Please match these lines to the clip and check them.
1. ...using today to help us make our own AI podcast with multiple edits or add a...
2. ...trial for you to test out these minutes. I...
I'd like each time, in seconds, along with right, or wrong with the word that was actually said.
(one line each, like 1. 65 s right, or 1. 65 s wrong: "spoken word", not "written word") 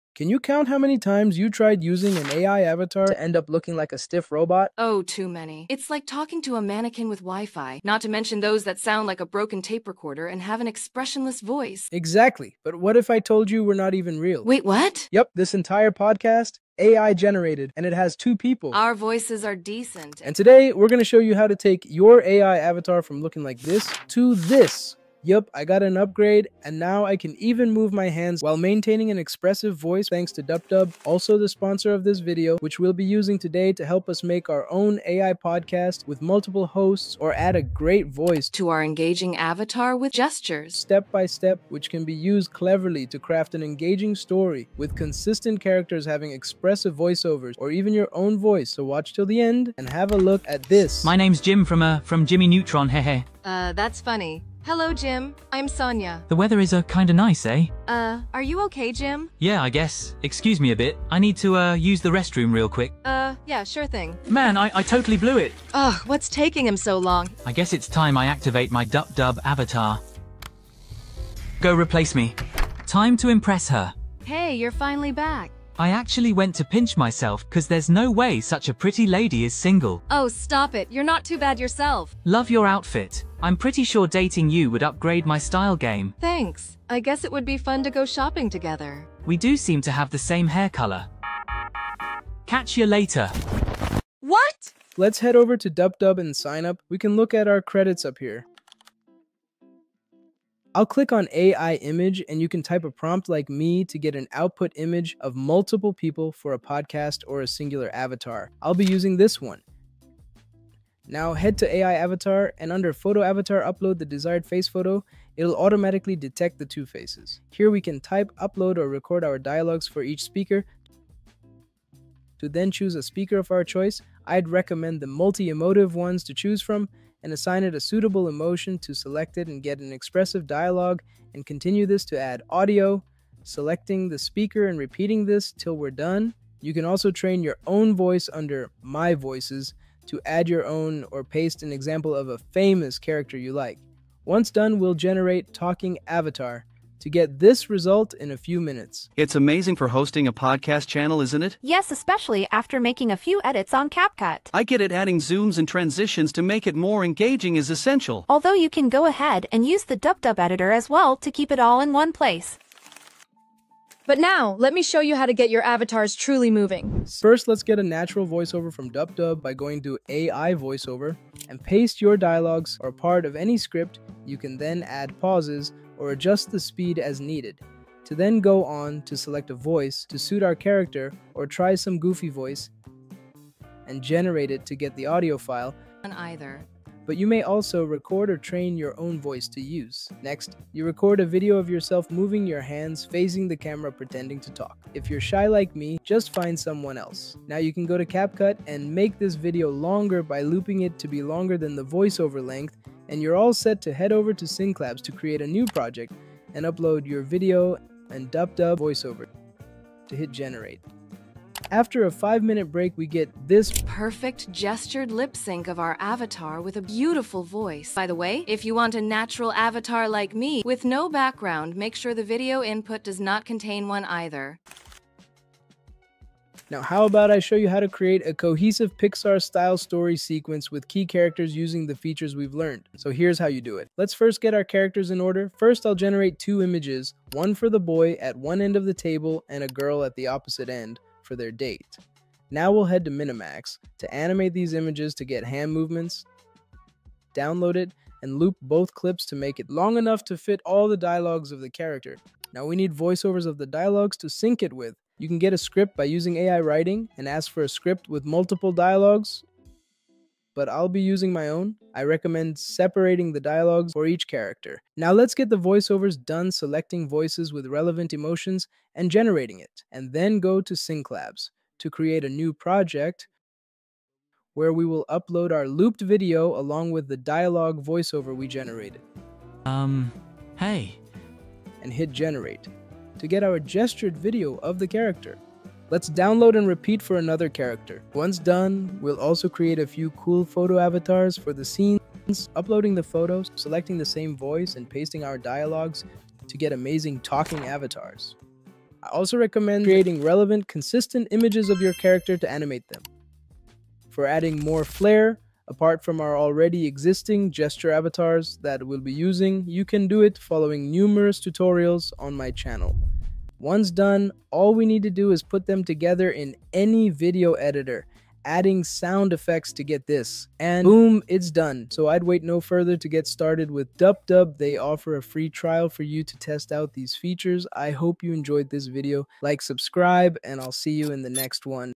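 1. 33 s wrong: "hosts", not "edits"
2. 325 s wrong: "features", not "minutes".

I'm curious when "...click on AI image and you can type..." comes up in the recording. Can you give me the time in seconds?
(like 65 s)
100 s.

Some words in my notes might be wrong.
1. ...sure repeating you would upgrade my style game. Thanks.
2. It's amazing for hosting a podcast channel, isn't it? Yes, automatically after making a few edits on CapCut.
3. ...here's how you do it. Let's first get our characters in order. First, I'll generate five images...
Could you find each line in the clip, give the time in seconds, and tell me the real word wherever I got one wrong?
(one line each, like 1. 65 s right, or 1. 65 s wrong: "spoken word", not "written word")
1. 83 s wrong: "dating", not "repeating"
2. 149 s wrong: "especially", not "automatically"
3. 233 s wrong: "two", not "five".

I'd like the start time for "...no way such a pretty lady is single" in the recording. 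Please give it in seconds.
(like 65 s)
77 s.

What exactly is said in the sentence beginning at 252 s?
Now we need voiceovers of the dialogues to sync it with.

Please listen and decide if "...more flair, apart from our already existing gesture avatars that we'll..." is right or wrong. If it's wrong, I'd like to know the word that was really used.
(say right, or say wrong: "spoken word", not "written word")
right.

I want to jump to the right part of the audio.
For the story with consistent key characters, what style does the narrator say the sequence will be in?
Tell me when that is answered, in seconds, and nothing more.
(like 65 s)
228 s.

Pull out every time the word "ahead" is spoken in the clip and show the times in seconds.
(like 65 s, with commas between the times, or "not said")
159 s.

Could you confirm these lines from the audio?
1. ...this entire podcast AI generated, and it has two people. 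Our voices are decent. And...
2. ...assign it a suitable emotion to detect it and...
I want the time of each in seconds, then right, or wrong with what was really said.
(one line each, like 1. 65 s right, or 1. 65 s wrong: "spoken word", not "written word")
1. 15 s right
2. 127 s wrong: "select", not "detect".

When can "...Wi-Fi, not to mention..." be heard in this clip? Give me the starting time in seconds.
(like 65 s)
7 s.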